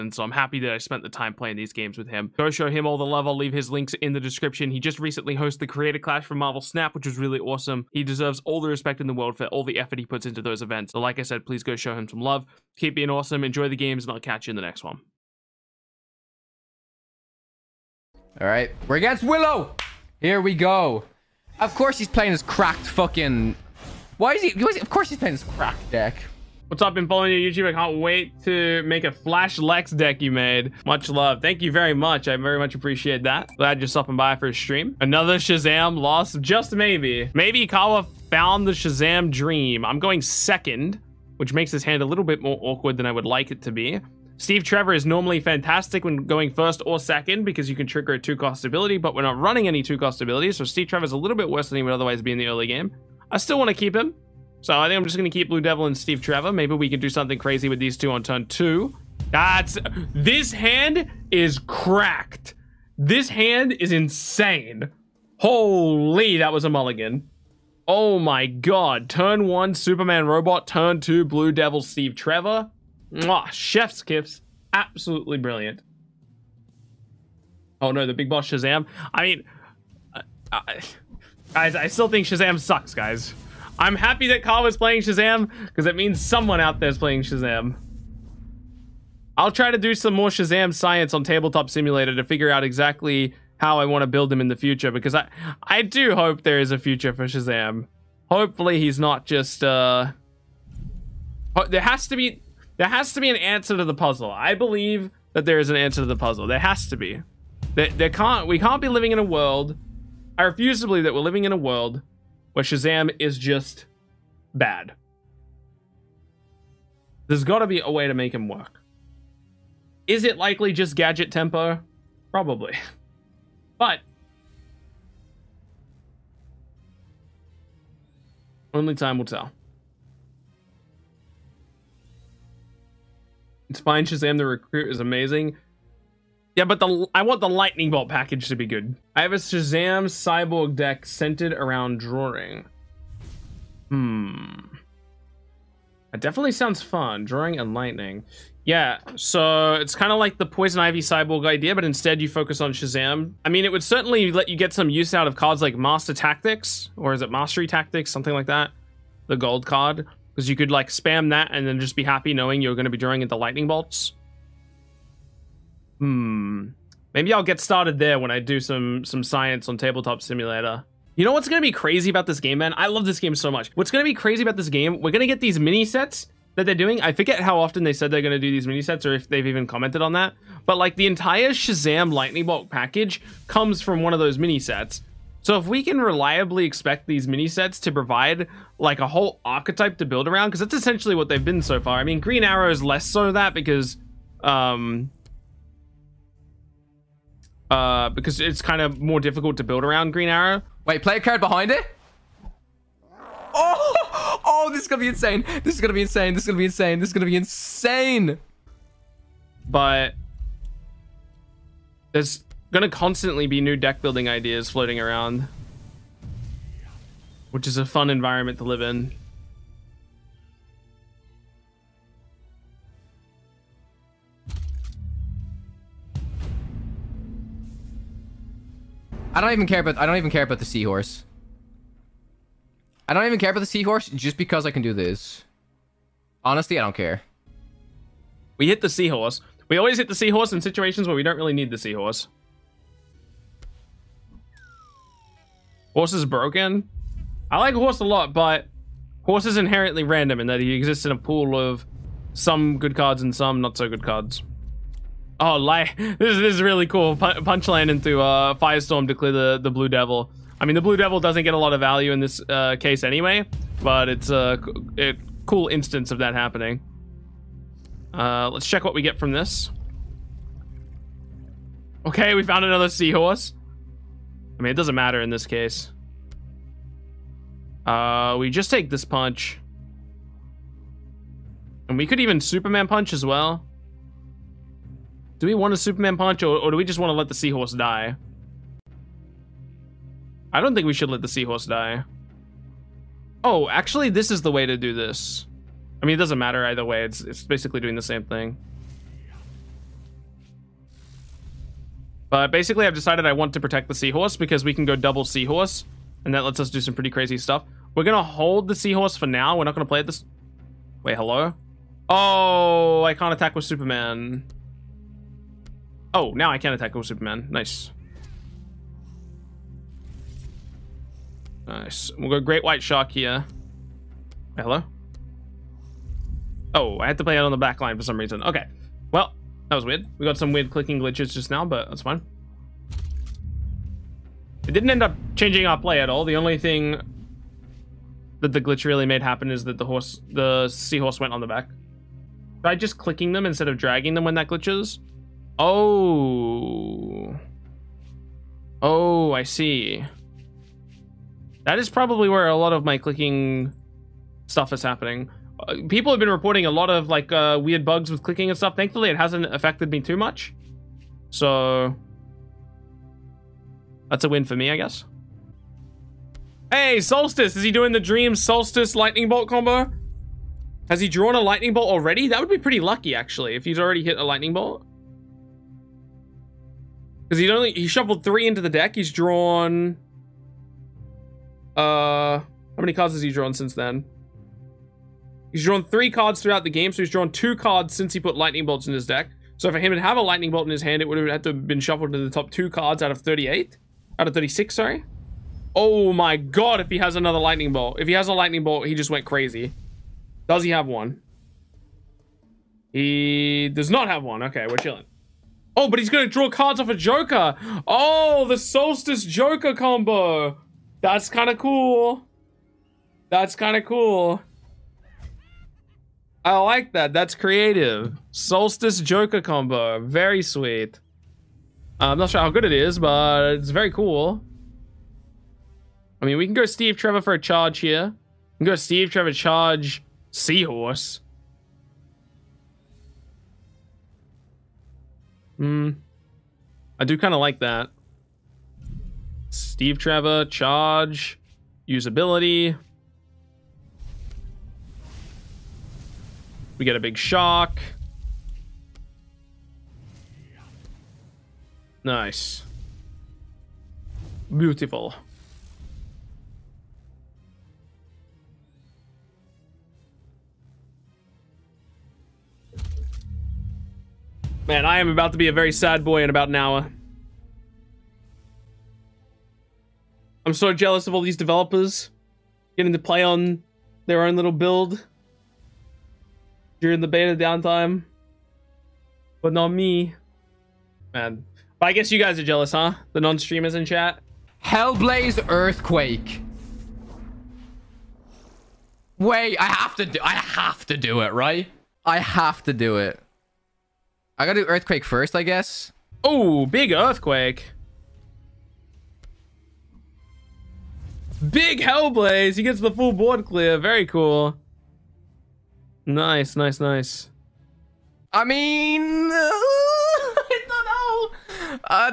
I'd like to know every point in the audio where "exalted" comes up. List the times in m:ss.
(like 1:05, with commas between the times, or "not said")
not said.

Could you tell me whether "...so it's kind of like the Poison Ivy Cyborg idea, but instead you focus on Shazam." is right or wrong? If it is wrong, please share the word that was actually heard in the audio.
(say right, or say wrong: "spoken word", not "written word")
right.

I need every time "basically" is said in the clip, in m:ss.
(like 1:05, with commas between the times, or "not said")
4:57, 5:02.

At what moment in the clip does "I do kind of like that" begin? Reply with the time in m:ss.
7:16.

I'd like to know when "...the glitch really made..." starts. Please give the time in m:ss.
5:38.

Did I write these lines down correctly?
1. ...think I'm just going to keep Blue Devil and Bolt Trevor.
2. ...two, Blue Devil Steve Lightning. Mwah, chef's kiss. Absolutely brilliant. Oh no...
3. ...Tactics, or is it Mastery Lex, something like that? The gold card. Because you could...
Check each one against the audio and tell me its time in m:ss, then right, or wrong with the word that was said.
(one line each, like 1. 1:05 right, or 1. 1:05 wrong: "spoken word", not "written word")
1. 0:54 wrong: "Steve", not "Bolt"
2. 1:10 wrong: "Trevor", not "Lightning"
3. 2:36 wrong: "Tactics", not "Lex".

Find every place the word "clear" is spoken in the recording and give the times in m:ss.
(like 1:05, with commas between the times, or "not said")
4:19, 8:23.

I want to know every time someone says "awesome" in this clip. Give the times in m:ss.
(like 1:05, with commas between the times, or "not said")
0:07, 0:13.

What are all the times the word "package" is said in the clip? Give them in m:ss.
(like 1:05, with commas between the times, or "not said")
2:18, 3:02.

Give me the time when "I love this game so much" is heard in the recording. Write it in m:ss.
2:52.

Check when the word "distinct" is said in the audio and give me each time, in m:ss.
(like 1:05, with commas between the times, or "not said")
not said.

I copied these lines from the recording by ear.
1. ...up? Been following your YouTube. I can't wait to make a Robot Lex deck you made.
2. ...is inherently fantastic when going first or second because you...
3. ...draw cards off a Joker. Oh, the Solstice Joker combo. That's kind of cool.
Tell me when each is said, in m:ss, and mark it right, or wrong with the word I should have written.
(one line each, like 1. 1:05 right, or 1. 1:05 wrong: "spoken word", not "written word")
1. 0:26 wrong: "Flash", not "Robot"
2. 0:44 wrong: "normally", not "inherently"
3. 6:46 right.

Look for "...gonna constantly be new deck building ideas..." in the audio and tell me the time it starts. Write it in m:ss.
3:32.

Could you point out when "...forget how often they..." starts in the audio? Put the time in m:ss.
2:57.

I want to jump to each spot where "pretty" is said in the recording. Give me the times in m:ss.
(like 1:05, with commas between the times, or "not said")
5:06, 6:12.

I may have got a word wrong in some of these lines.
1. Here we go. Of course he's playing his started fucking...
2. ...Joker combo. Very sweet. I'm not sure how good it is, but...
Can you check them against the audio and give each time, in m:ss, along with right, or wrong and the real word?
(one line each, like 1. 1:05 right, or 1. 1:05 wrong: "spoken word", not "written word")
1. 0:20 wrong: "cracked", not "started"
2. 6:58 right.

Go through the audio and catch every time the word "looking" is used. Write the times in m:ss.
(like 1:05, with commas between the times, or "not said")
not said.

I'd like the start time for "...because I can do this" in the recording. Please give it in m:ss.
3:54.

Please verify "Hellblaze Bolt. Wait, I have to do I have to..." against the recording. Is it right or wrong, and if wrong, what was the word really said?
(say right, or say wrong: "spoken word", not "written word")
wrong: "Earthquake", not "Bolt".